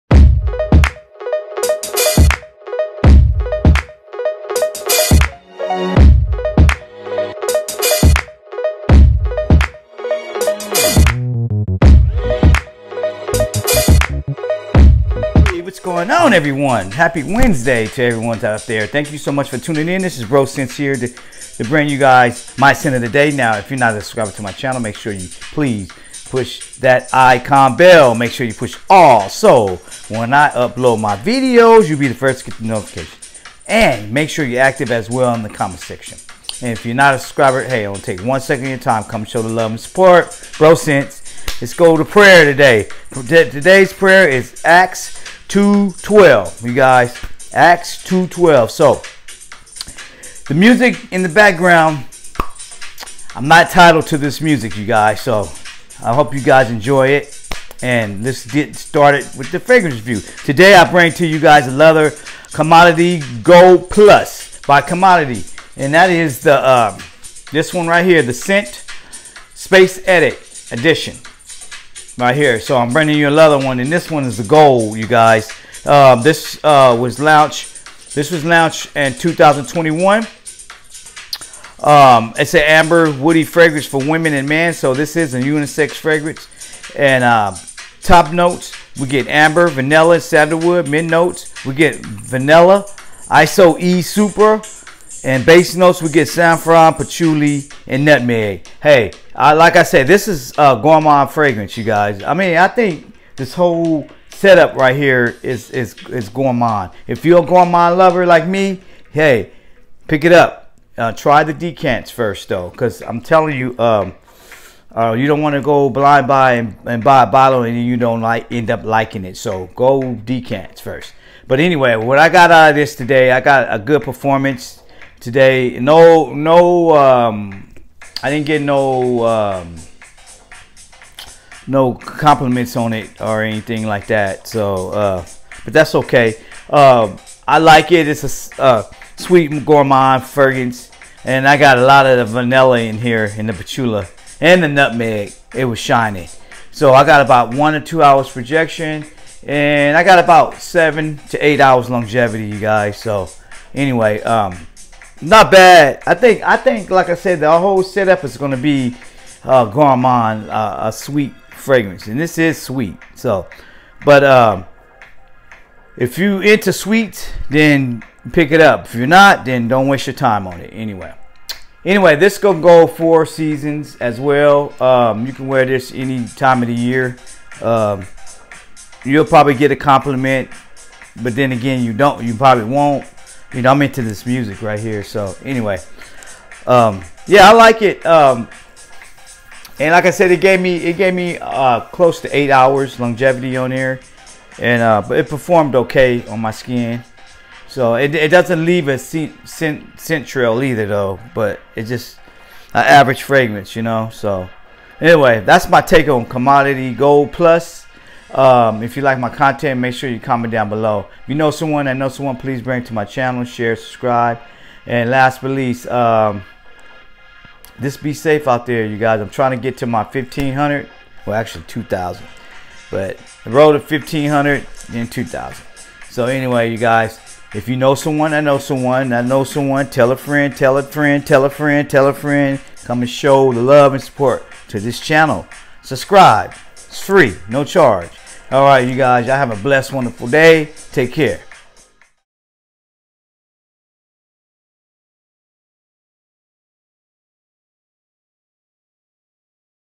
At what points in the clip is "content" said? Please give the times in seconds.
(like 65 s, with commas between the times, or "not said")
209 s.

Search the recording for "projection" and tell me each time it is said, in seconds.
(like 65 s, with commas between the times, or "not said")
148 s.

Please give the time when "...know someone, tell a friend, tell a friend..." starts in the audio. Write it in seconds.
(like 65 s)
229 s.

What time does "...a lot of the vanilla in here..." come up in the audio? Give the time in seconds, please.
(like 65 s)
141 s.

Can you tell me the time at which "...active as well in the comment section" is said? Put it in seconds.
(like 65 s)
34 s.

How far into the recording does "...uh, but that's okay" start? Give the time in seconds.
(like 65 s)
134 s.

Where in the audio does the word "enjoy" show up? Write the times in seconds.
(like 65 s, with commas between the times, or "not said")
56 s.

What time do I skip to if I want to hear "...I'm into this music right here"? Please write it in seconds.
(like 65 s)
183 s.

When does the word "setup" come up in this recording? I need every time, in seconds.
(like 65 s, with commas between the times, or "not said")
104 s, 157 s.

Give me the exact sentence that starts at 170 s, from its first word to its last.
Anyway, anyway, this gonna go four seasons as well.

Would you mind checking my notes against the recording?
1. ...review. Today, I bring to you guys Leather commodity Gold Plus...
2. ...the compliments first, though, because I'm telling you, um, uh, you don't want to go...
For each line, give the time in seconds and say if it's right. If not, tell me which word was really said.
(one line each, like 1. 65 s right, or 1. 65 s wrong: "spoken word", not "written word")
1. 59 s right
2. 111 s wrong: "decants", not "compliments".